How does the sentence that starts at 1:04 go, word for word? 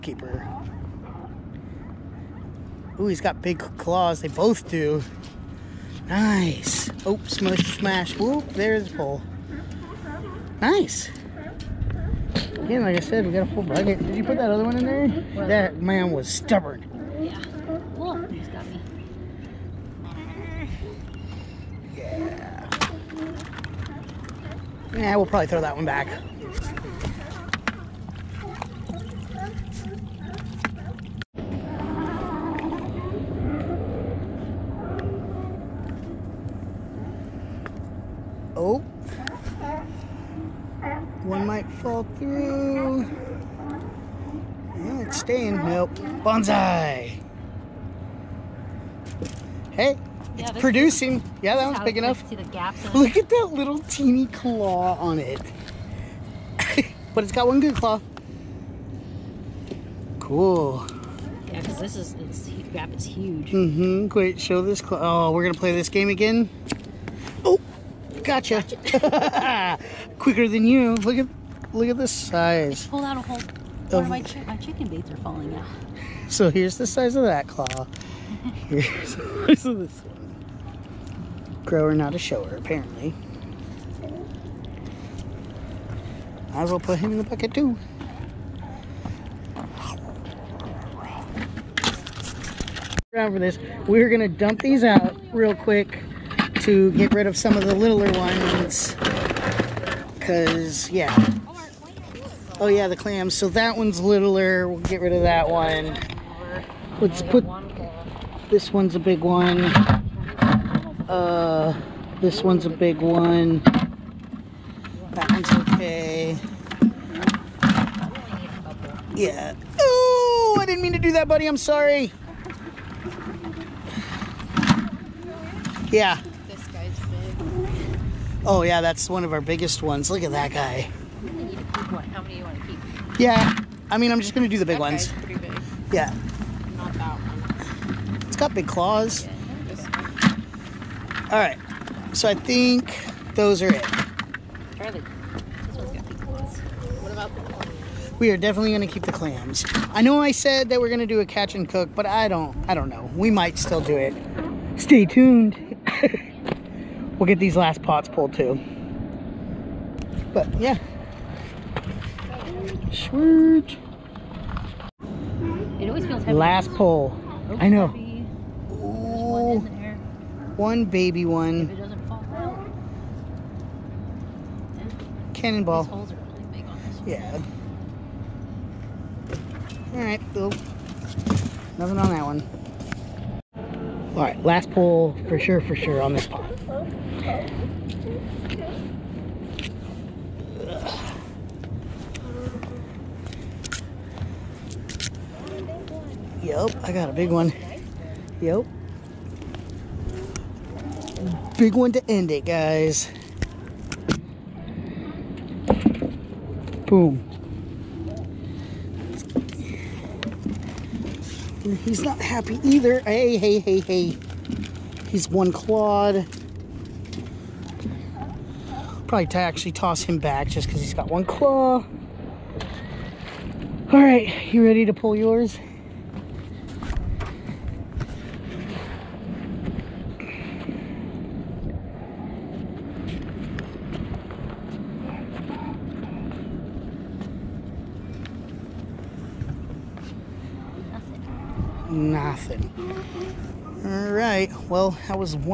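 Oh, we're going to play this game again?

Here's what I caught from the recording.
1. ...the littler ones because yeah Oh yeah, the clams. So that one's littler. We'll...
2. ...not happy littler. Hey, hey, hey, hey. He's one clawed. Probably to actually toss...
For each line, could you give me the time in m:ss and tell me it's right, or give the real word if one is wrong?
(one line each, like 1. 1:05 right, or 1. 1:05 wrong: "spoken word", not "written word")
1. 1:37 right
2. 3:32 wrong: "either", not "littler".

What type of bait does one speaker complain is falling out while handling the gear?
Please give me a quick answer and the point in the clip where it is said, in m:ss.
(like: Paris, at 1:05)
chicken baits, at 1:14.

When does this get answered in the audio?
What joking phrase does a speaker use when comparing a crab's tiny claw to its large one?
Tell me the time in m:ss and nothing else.
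1:21.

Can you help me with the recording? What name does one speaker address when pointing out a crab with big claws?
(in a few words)
Charlie.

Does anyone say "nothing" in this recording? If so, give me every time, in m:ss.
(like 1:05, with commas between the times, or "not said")
3:01, 4:01.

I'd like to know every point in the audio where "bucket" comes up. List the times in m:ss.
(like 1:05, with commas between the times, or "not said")
0:13, 1:27.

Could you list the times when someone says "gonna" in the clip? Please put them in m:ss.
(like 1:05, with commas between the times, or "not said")
1:34.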